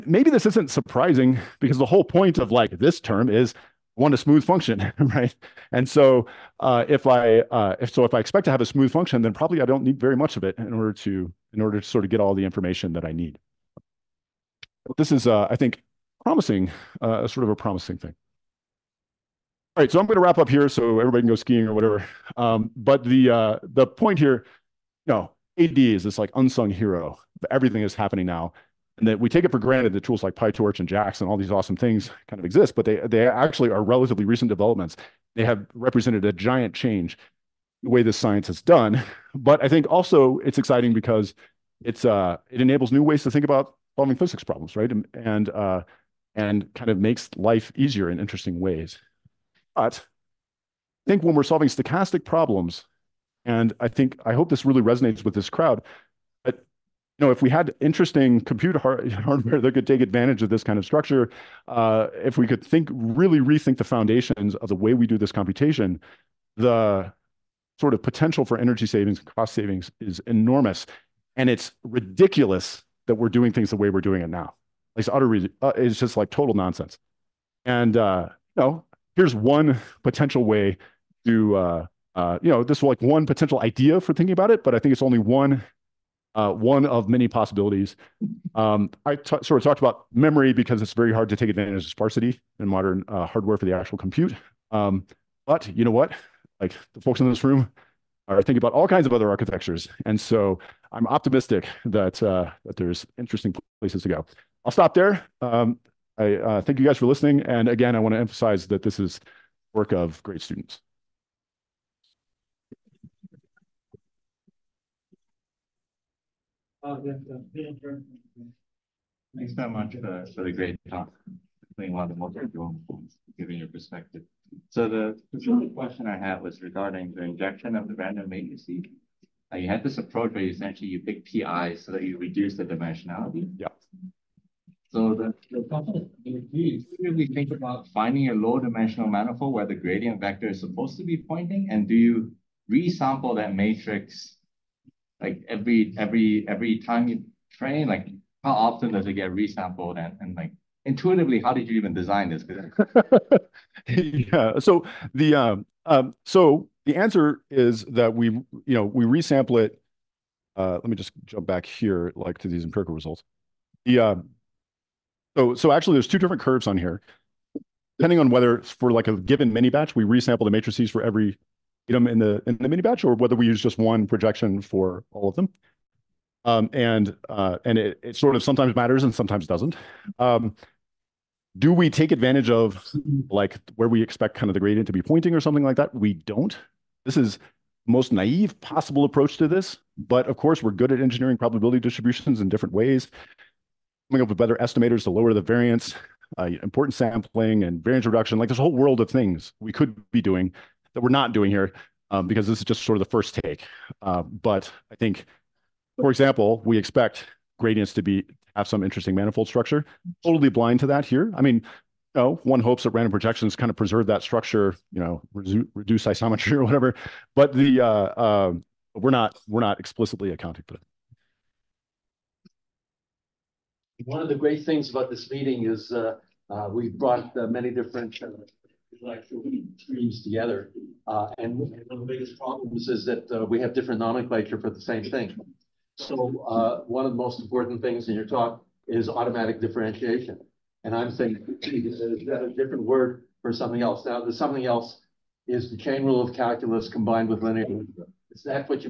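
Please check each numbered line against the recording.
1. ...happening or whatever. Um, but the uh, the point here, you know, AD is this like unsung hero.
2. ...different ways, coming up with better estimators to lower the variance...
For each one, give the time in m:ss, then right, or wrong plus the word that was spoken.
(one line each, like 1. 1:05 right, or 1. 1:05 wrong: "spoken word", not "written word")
1. 0:21 wrong: "skiing", not "happening"
2. 3:12 right.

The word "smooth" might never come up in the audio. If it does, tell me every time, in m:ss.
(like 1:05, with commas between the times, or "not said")
0:04, 0:08.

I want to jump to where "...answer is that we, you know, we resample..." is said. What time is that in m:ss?
2:36.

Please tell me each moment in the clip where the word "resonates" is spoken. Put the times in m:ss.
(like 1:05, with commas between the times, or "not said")
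0:54.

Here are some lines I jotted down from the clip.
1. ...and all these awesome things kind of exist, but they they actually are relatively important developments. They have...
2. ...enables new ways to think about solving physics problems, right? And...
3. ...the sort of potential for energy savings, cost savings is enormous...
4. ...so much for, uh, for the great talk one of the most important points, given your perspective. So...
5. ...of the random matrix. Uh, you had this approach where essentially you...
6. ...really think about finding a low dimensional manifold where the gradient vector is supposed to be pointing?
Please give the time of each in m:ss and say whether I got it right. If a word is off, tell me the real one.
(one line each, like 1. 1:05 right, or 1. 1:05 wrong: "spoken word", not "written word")
1. 0:31 wrong: "recent", not "important"
2. 0:42 right
3. 1:06 right
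4. 1:59 right
5. 2:07 right
6. 2:16 right.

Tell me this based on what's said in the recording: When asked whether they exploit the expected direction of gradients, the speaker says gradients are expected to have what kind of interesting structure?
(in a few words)
manifold structure.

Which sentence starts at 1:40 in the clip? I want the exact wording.
And so I'm optimistic that, uh, that there's interesting places to go.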